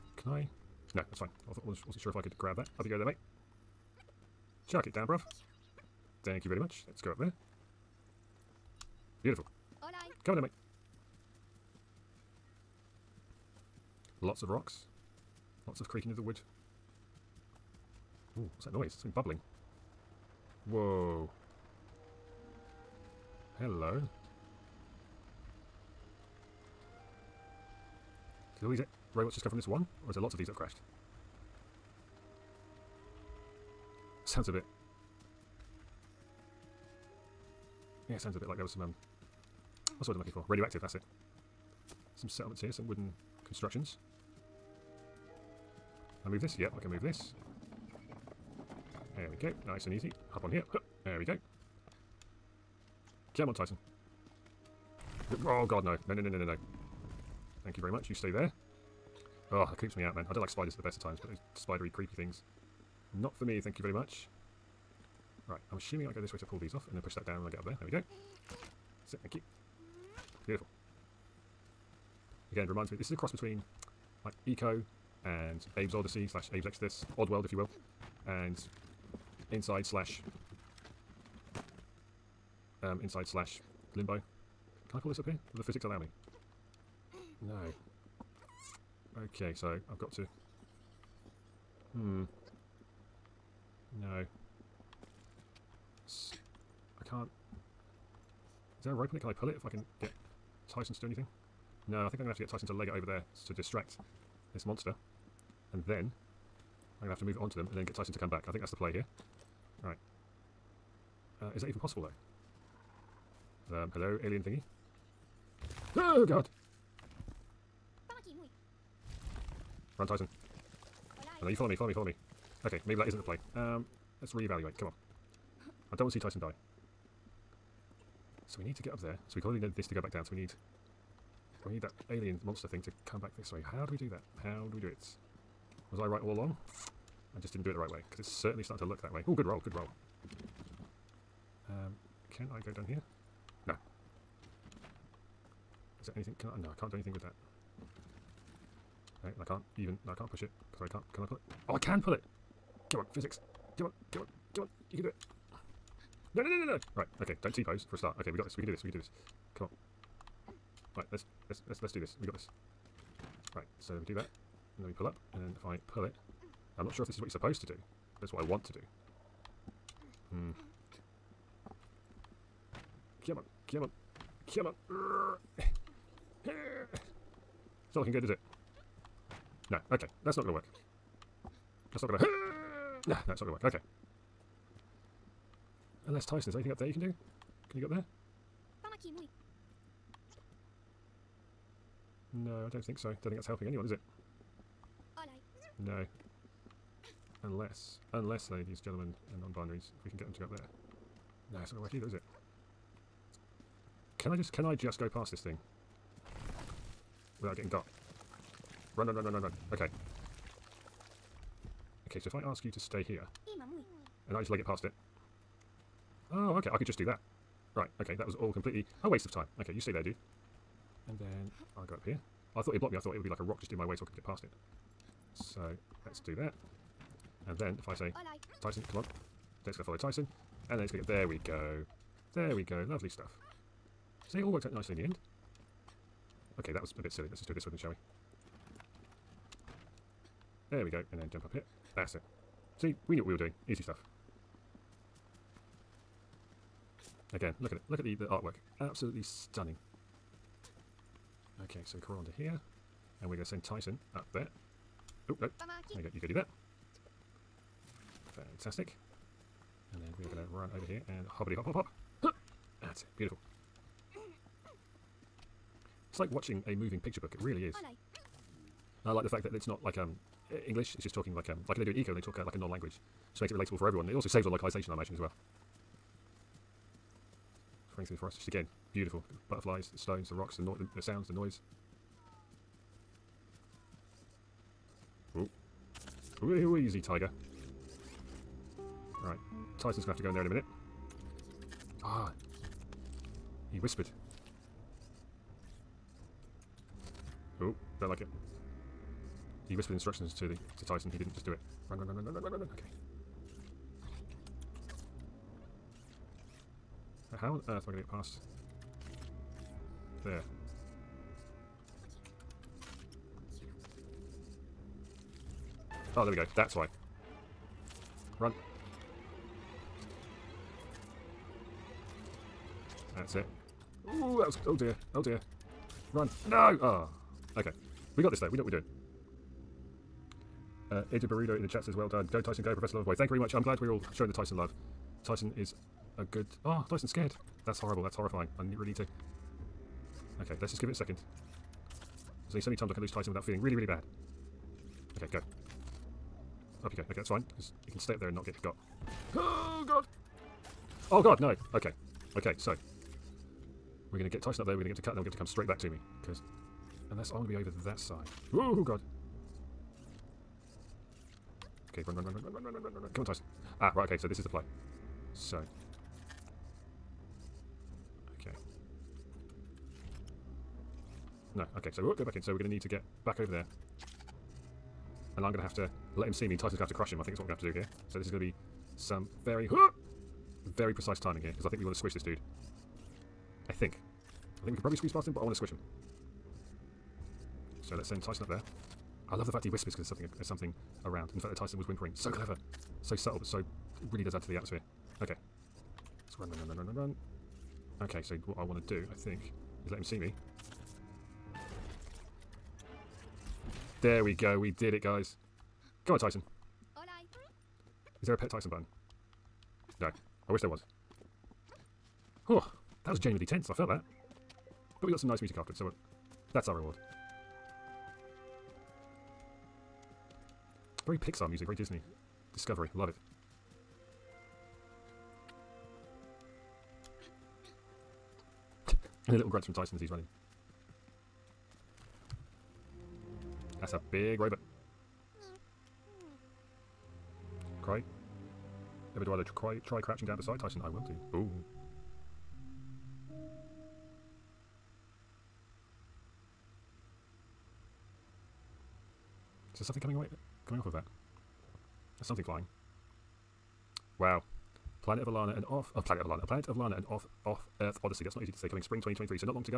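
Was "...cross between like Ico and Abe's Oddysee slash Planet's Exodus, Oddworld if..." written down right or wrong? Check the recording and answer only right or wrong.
wrong.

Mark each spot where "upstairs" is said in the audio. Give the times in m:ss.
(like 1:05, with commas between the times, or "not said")
not said.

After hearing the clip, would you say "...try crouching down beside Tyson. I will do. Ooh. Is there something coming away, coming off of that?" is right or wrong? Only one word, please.
right.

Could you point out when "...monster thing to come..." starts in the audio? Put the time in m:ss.
2:12.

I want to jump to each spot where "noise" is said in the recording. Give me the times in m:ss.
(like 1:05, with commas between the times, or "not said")
0:18, 4:41.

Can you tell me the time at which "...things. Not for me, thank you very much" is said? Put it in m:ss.
1:02.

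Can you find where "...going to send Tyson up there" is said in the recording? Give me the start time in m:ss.
4:13.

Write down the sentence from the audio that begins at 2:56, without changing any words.
it's not looking good, is it?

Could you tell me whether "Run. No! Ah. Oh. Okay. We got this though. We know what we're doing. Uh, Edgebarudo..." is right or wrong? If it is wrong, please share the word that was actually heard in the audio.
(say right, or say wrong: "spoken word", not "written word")
right.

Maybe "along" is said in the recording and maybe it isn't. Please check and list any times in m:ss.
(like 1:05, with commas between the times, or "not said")
2:16.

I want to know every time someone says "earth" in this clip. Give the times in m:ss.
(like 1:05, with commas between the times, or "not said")
5:07, 7:37.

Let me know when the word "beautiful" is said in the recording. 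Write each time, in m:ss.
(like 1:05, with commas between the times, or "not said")
0:09, 1:10, 4:23, 4:38.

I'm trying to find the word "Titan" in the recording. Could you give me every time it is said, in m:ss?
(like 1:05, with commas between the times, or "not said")
1:47, 2:00, 6:16.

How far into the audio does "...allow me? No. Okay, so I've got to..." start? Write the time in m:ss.
1:25.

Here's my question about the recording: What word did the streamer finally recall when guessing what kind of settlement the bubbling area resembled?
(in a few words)
Radioactive.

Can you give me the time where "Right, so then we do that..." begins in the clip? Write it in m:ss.
2:43.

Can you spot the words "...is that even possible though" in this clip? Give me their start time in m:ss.
1:51.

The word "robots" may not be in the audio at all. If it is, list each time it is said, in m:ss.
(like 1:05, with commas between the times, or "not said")
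0:29, 7:14.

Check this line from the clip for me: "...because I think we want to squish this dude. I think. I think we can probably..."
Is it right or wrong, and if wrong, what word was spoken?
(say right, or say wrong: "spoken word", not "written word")
right.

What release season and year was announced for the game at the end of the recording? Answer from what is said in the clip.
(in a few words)
Spring 2023.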